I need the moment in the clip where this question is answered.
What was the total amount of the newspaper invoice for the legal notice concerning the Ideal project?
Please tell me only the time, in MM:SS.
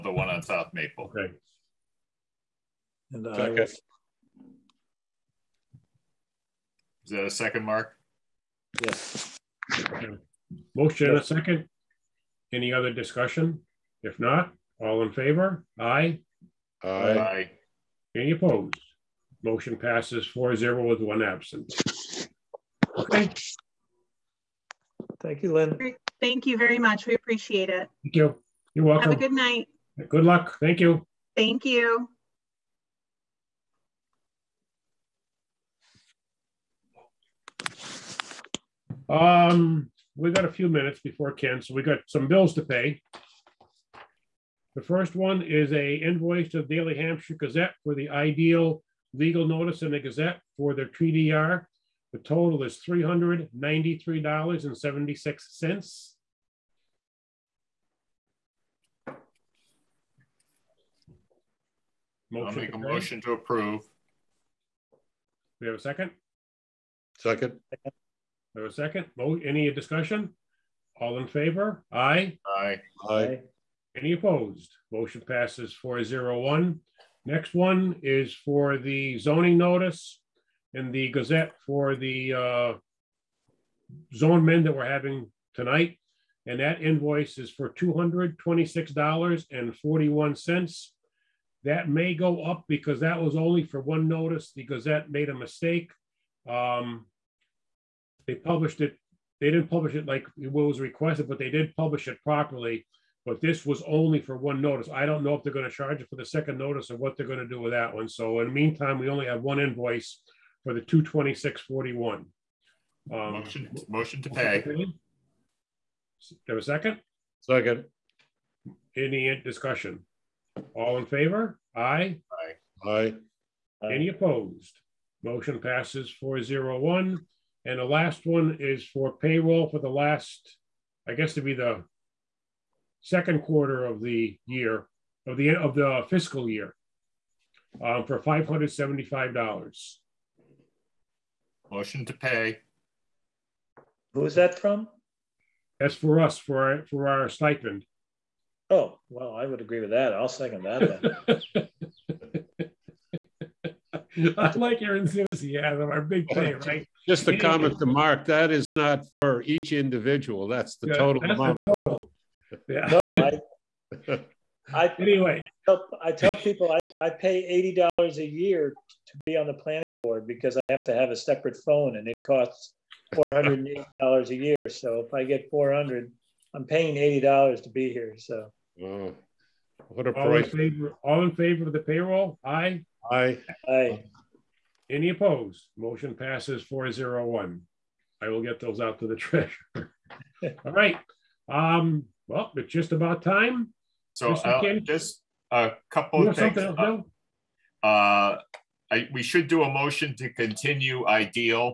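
00:52.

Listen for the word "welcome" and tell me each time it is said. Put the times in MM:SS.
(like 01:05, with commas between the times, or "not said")
00:28.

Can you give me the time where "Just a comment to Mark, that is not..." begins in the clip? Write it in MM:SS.
02:37.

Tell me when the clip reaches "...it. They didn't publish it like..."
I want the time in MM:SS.
01:38.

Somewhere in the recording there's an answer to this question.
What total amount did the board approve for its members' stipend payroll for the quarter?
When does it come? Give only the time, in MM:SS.
02:18.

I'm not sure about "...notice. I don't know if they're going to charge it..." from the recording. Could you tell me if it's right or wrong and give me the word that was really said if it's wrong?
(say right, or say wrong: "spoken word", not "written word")
right.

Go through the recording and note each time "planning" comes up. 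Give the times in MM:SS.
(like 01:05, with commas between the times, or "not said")
02:49.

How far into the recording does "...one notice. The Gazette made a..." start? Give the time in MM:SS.
01:33.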